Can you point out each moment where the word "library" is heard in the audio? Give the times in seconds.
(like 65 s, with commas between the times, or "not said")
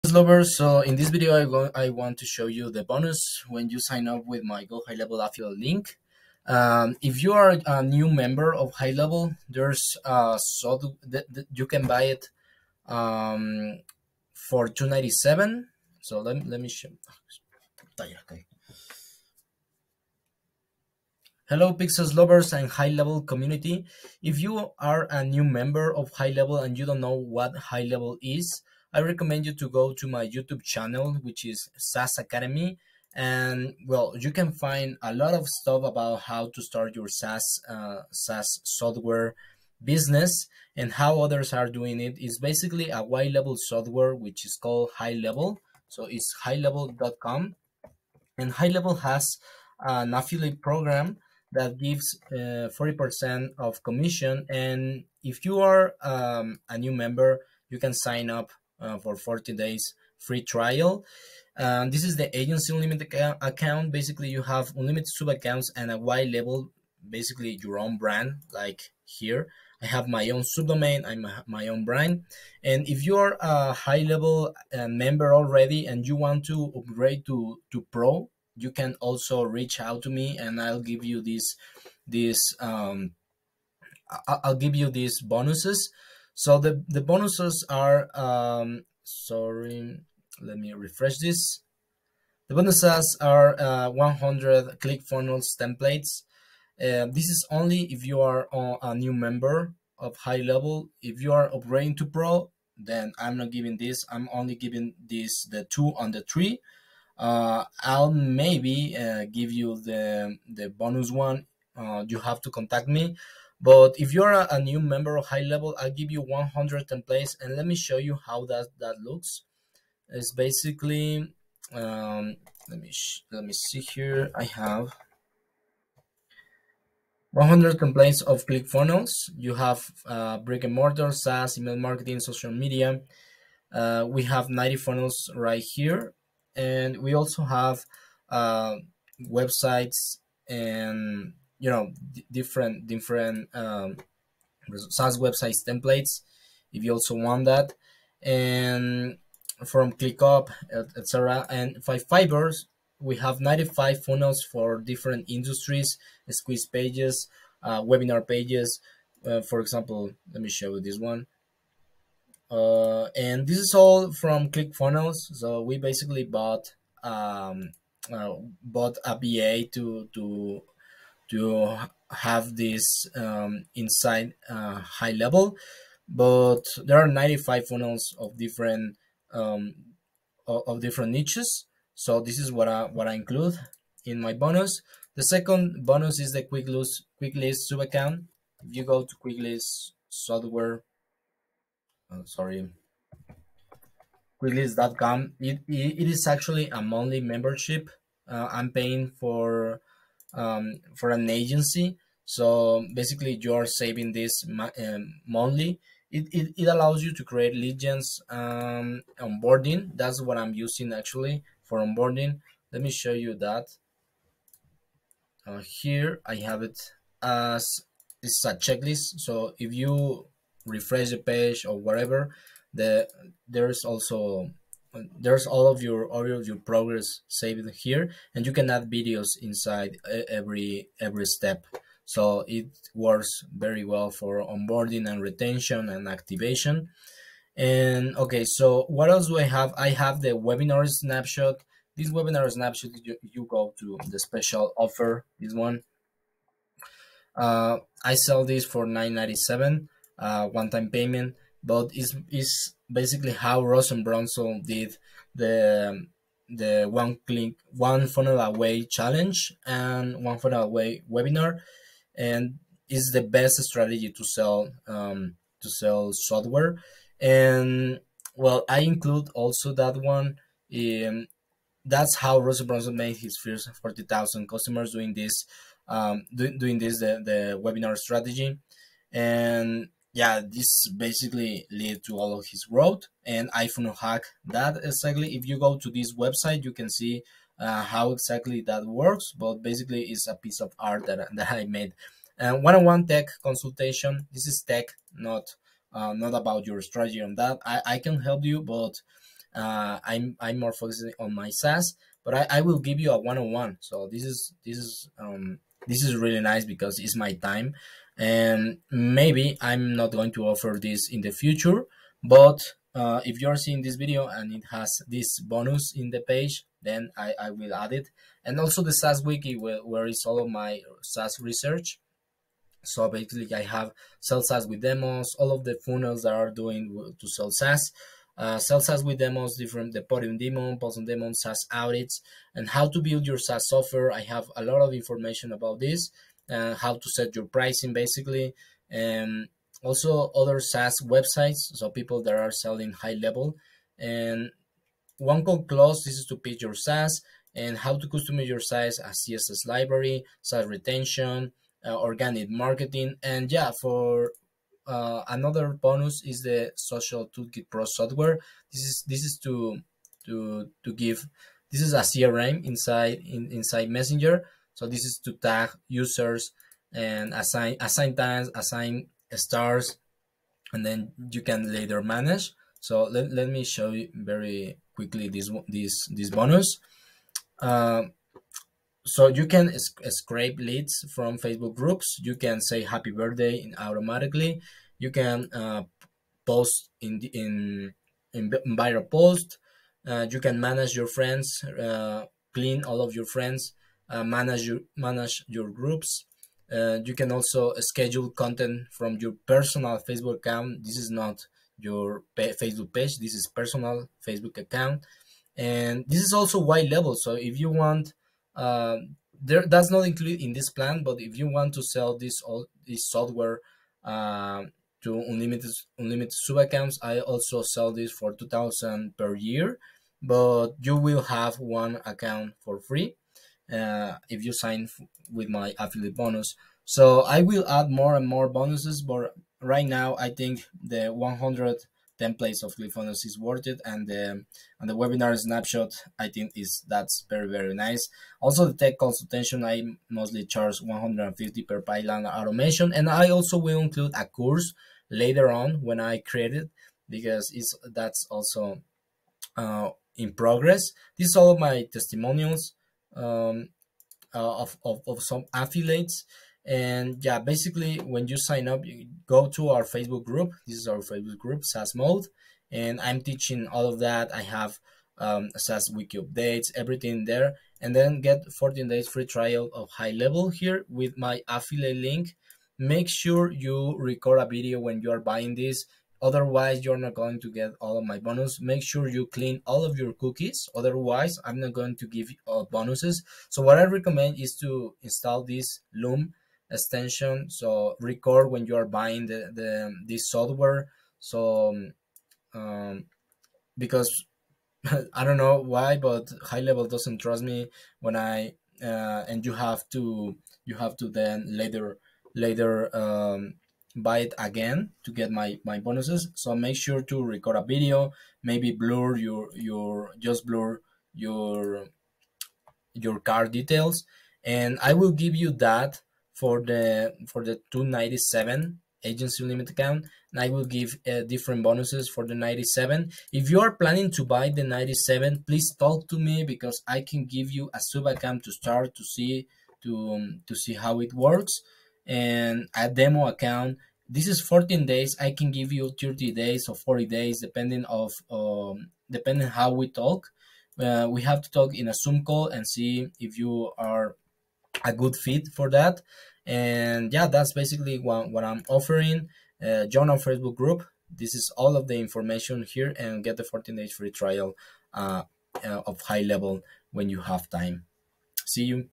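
349 s.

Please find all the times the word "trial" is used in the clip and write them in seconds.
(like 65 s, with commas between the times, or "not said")
60 s, 469 s, 554 s.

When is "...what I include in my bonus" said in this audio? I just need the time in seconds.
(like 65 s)
182 s.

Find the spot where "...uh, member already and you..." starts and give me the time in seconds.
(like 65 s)
74 s.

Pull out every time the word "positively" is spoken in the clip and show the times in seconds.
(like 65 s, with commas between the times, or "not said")
not said.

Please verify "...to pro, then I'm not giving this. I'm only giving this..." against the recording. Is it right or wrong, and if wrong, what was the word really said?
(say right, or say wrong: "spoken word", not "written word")
right.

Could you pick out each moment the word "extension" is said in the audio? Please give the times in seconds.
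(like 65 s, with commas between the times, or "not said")
486 s.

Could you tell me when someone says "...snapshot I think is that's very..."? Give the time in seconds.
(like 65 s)
435 s.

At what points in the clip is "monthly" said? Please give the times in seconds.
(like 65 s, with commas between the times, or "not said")
196 s, 205 s.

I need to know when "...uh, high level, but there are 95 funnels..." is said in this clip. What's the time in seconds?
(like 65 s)
174 s.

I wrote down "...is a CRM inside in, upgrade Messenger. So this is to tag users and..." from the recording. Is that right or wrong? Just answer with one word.
wrong.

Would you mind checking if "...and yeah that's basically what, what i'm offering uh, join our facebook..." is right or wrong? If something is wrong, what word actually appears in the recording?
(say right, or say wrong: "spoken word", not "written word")
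right.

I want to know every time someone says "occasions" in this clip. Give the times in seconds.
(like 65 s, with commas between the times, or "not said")
not said.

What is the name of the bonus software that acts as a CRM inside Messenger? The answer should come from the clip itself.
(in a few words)
Social Toolkit Pro.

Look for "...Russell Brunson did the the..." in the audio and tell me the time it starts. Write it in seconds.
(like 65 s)
253 s.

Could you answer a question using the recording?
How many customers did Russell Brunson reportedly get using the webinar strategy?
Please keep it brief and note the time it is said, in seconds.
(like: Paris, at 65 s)
40,000, at 273 s.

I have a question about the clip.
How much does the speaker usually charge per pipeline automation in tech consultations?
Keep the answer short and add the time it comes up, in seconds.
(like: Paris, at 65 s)
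150, at 440 s.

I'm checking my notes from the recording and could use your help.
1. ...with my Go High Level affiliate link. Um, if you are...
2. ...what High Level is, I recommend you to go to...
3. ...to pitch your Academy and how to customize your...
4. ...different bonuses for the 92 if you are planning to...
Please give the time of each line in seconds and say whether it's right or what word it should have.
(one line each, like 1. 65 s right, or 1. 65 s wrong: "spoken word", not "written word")
1. 4 s right
2. 27 s right
3. 346 s wrong: "SaaS", not "Academy"
4. 521 s wrong: "97", not "92".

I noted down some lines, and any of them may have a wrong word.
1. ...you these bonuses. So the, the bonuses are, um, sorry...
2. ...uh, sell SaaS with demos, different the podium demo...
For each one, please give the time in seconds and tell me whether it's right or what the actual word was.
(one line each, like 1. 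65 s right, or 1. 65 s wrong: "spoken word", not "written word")
1. 84 s right
2. 328 s right.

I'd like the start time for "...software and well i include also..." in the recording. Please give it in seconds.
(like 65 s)
266 s.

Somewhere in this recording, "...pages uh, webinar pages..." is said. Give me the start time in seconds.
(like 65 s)
156 s.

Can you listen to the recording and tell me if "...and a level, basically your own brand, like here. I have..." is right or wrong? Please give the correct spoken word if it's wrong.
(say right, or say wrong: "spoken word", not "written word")
right.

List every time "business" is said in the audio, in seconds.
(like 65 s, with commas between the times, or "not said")
39 s.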